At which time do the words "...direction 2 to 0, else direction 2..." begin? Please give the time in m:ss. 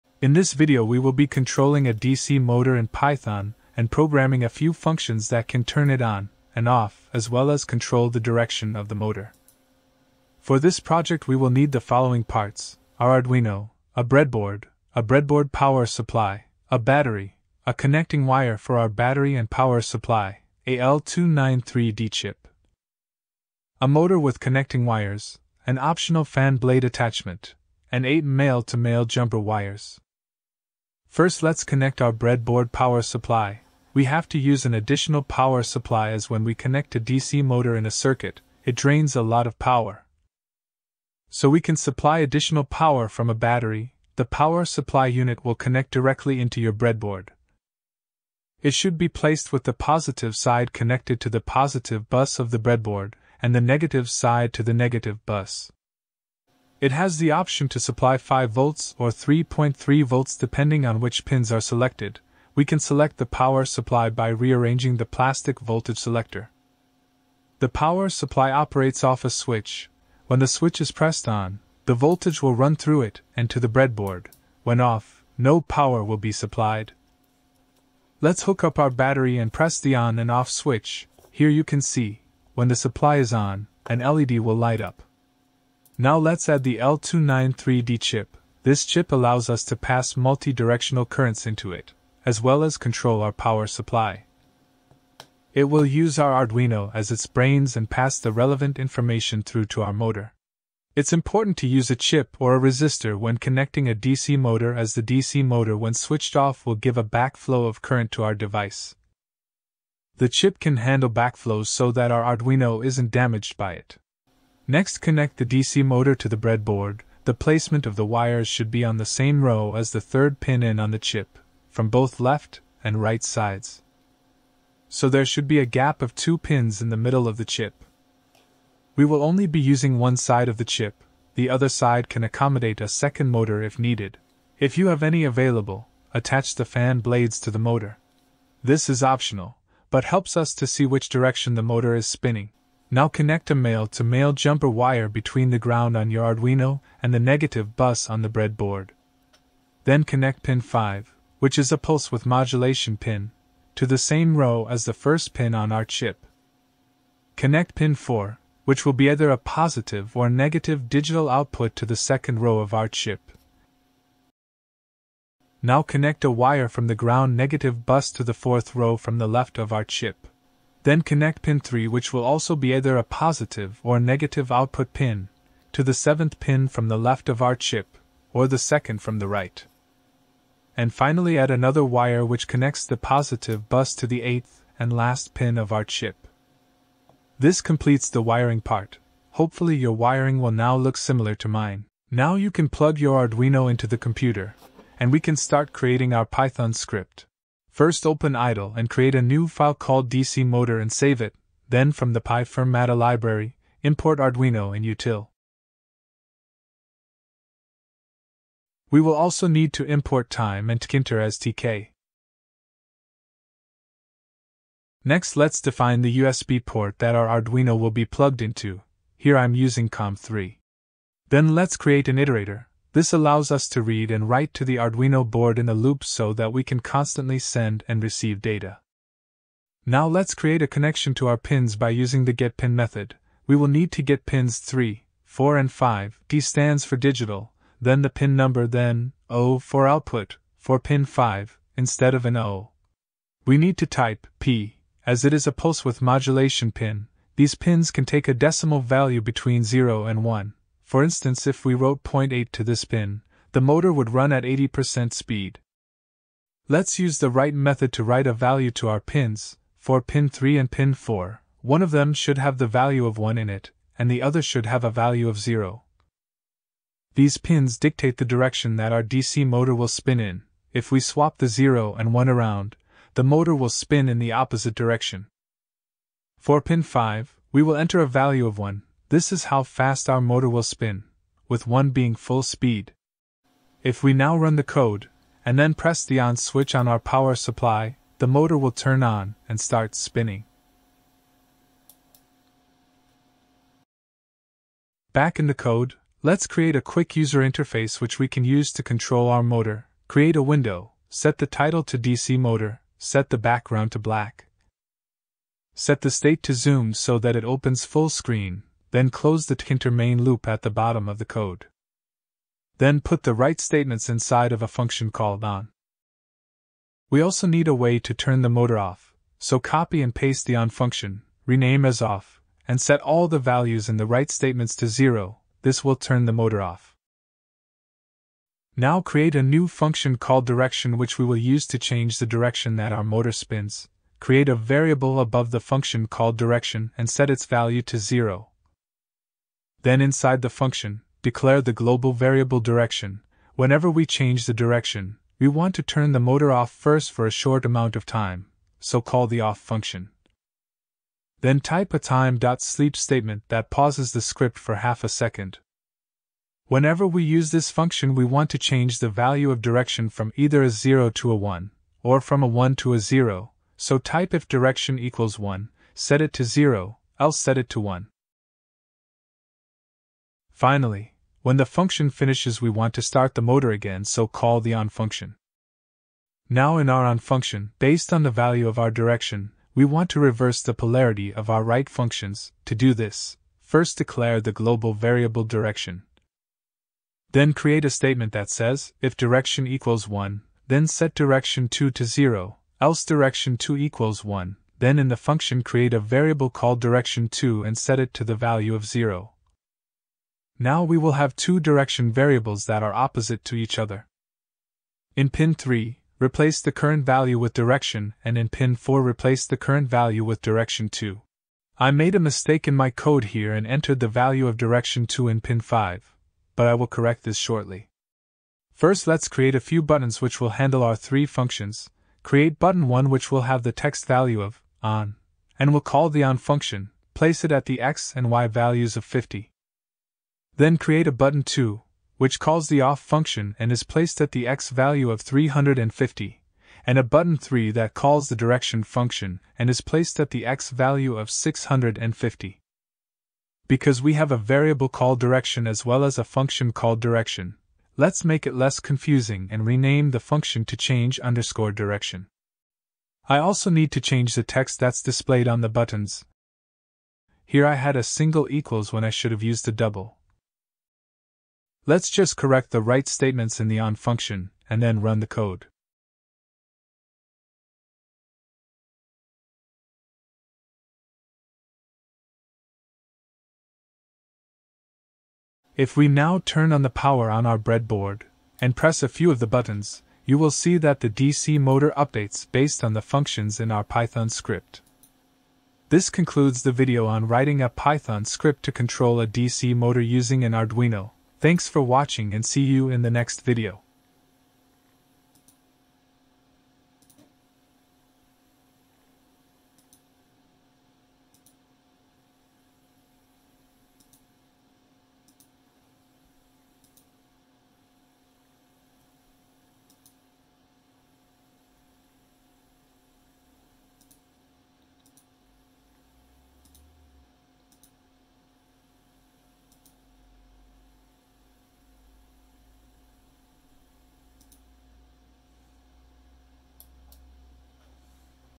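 6:31.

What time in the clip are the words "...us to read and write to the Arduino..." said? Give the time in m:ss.
3:43.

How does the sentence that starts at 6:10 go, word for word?
Finally, when the function finishes, we want to start the motor again, so call the on function.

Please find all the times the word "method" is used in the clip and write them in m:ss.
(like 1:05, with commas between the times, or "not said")
3:52, 4:17.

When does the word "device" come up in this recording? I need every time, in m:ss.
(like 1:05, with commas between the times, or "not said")
1:48.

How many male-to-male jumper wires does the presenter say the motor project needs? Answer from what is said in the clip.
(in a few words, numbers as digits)
8.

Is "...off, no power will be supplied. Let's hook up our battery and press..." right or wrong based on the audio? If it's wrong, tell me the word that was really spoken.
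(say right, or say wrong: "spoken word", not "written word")
right.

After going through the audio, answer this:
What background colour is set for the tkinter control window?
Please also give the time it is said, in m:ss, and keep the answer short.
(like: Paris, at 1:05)
Black, at 5:03.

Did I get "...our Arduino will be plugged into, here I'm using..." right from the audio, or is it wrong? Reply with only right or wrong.
right.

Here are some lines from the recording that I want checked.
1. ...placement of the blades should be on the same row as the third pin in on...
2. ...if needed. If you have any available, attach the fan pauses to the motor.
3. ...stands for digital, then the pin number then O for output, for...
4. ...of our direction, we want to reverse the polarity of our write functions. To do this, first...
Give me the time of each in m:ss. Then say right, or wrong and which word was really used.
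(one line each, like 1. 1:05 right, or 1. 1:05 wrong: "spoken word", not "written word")
1. 1:57 wrong: "wires", not "blades"
2. 2:13 wrong: "blades", not "pauses"
3. 3:56 right
4. 6:18 right.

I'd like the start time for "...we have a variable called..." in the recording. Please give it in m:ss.
7:24.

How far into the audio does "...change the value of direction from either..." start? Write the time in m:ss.
5:58.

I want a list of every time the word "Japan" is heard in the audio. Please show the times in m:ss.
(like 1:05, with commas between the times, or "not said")
not said.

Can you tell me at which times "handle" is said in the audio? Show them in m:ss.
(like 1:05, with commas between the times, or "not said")
1:50, 7:00.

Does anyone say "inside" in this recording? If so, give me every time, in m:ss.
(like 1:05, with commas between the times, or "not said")
5:14, 5:40.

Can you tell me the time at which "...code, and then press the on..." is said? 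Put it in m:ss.
4:44.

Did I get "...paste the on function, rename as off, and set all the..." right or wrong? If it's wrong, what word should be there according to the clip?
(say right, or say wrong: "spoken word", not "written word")
right.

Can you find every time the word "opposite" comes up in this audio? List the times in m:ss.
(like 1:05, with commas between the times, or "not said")
4:34, 6:42.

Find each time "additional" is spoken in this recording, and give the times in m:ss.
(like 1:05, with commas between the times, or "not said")
0:34, 0:42.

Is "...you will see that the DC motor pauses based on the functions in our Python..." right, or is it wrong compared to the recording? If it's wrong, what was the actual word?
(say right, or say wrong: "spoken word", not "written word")
wrong: "updates", not "pauses".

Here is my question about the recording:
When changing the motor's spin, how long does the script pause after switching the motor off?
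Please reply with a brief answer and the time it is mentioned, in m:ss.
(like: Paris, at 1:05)
Half a second, at 5:54.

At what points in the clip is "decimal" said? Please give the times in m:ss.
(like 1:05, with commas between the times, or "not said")
4:08.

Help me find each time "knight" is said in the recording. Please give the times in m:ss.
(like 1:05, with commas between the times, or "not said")
not said.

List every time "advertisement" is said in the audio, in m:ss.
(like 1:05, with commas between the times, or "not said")
not said.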